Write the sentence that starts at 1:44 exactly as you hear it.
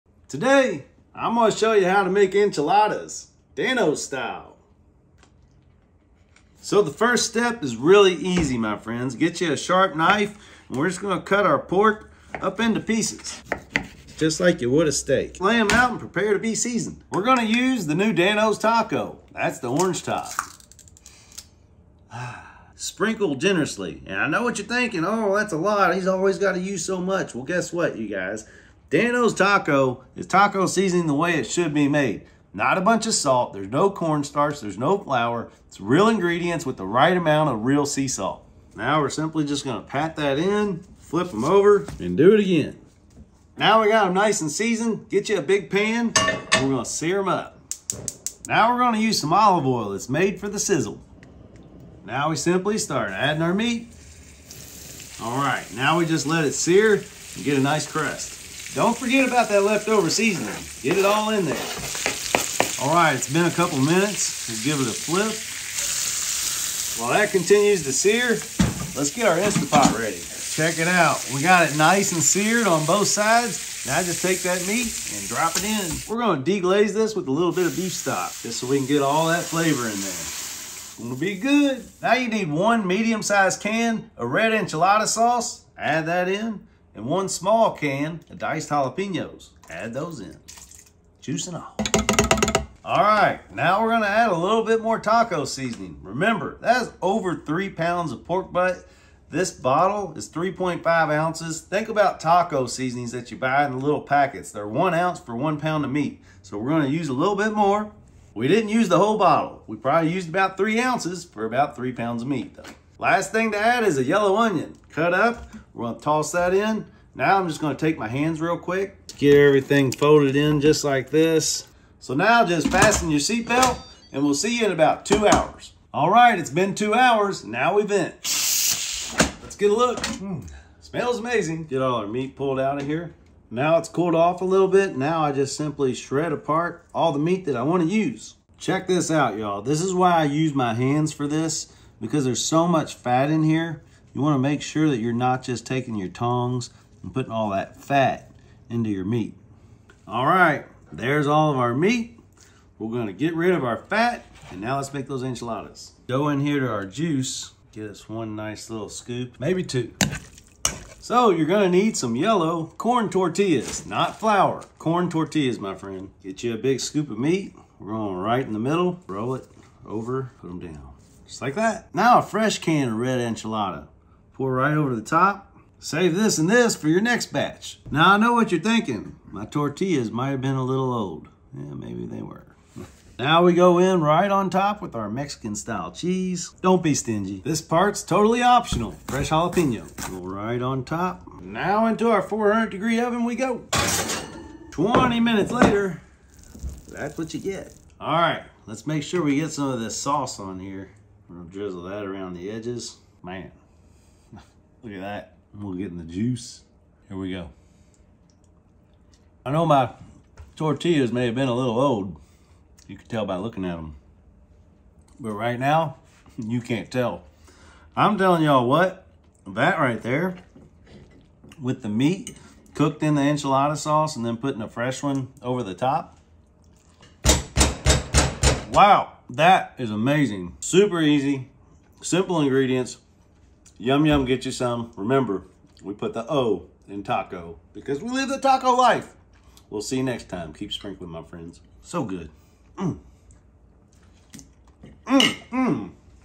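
They're one ounce for one pound of meat.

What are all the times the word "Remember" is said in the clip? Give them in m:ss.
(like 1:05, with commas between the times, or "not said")
1:36, 3:54.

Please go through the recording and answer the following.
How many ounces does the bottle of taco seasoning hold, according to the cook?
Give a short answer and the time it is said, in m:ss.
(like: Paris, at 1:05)
3.5 ounces, at 1:40.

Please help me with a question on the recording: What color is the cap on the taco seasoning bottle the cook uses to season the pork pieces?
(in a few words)
Orange.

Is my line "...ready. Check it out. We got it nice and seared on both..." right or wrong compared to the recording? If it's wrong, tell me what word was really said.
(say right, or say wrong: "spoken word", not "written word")
right.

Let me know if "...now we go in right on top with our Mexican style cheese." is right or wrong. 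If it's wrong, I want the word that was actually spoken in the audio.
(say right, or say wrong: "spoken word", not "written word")
right.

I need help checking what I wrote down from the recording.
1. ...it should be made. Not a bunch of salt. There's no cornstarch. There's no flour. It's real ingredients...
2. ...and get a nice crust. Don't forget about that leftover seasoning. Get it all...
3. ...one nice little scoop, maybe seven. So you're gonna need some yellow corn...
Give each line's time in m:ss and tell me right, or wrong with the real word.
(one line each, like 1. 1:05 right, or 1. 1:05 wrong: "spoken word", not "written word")
1. 0:31 right
2. 0:56 right
3. 2:38 wrong: "two", not "seven".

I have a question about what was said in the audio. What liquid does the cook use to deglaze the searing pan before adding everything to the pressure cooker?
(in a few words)
Beef stock.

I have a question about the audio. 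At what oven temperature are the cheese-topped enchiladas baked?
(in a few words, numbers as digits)
400 degrees.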